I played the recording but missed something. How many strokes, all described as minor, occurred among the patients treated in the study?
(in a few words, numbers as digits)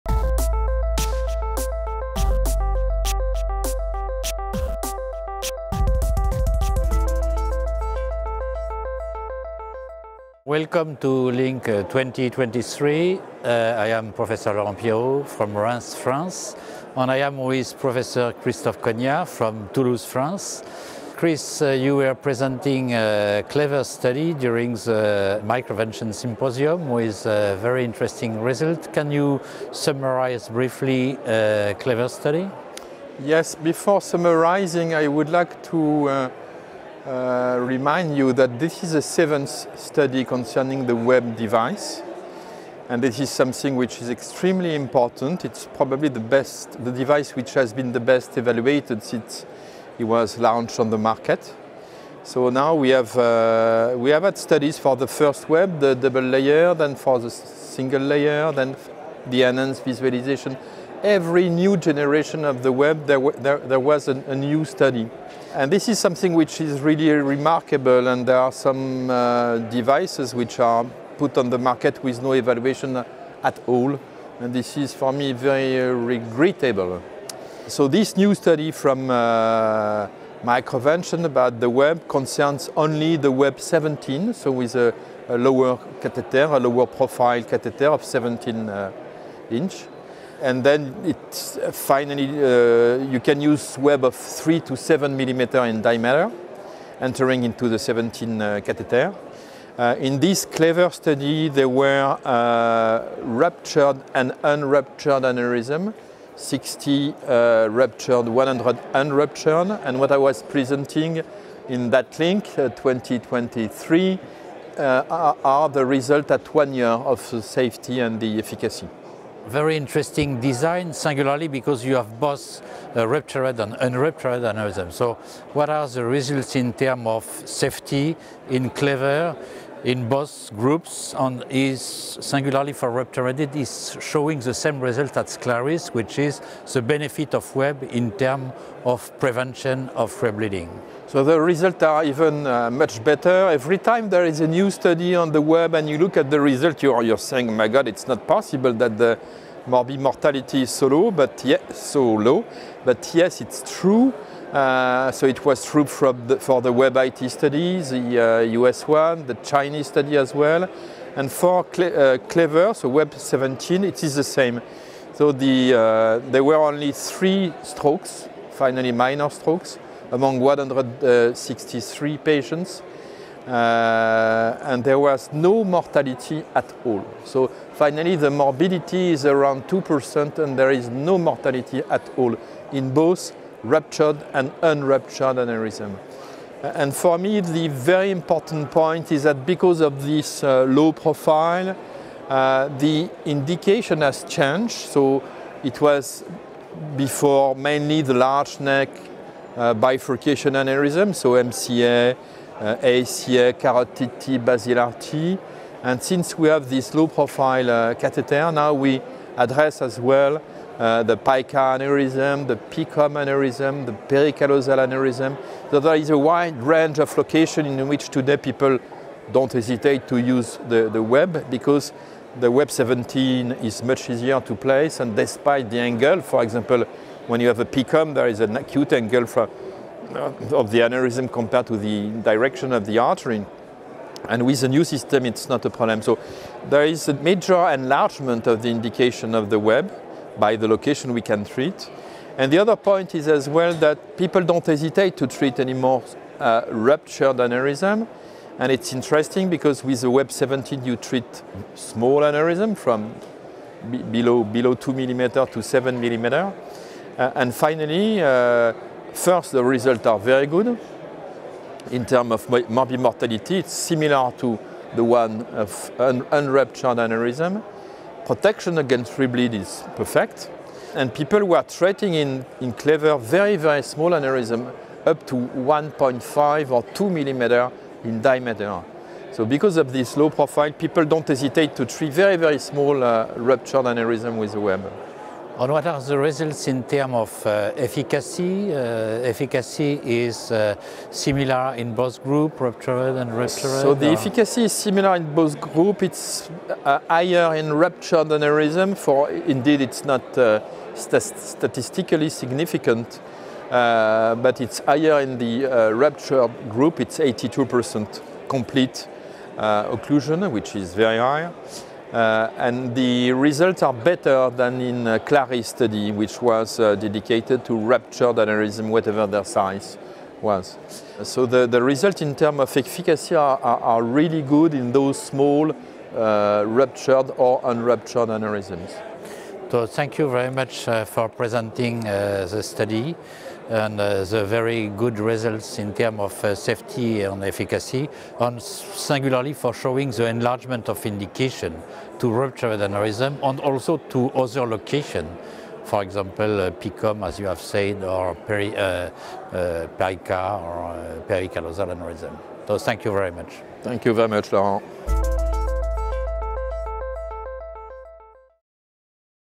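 3.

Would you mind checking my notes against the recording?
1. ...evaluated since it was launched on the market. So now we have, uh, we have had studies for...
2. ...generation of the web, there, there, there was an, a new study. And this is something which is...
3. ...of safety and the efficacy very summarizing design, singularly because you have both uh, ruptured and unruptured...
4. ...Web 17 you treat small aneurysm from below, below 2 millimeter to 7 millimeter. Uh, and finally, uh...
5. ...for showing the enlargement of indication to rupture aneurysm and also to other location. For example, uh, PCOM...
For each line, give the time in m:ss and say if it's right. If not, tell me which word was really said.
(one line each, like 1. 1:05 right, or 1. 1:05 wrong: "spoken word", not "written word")
1. 0:48 right
2. 1:01 right
3. 1:56 wrong: "interesting", not "summarizing"
4. 4:10 right
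5. 5:39 right.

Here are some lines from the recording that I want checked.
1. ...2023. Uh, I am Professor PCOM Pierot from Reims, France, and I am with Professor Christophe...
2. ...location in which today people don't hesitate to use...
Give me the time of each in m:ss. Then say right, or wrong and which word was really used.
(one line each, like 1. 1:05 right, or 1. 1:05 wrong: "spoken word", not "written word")
1. 0:11 wrong: "Laurent", not "PCOM"
2. 3:37 right.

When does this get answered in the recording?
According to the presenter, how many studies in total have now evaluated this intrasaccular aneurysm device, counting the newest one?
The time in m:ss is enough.
0:39.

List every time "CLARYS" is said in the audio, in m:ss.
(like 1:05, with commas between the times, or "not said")
2:15, 5:15.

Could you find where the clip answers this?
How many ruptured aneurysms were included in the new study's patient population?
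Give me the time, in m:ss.
1:46.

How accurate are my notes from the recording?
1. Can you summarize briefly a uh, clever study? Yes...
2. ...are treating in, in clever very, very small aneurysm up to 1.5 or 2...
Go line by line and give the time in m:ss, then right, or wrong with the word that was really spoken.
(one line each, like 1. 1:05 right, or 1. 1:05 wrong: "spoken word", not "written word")
1. 0:28 right
2. 4:31 right.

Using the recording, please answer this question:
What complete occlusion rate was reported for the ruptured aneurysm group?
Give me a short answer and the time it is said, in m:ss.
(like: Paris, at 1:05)
82%, at 5:07.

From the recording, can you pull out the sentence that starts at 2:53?
Uh, and there was no mortality at all.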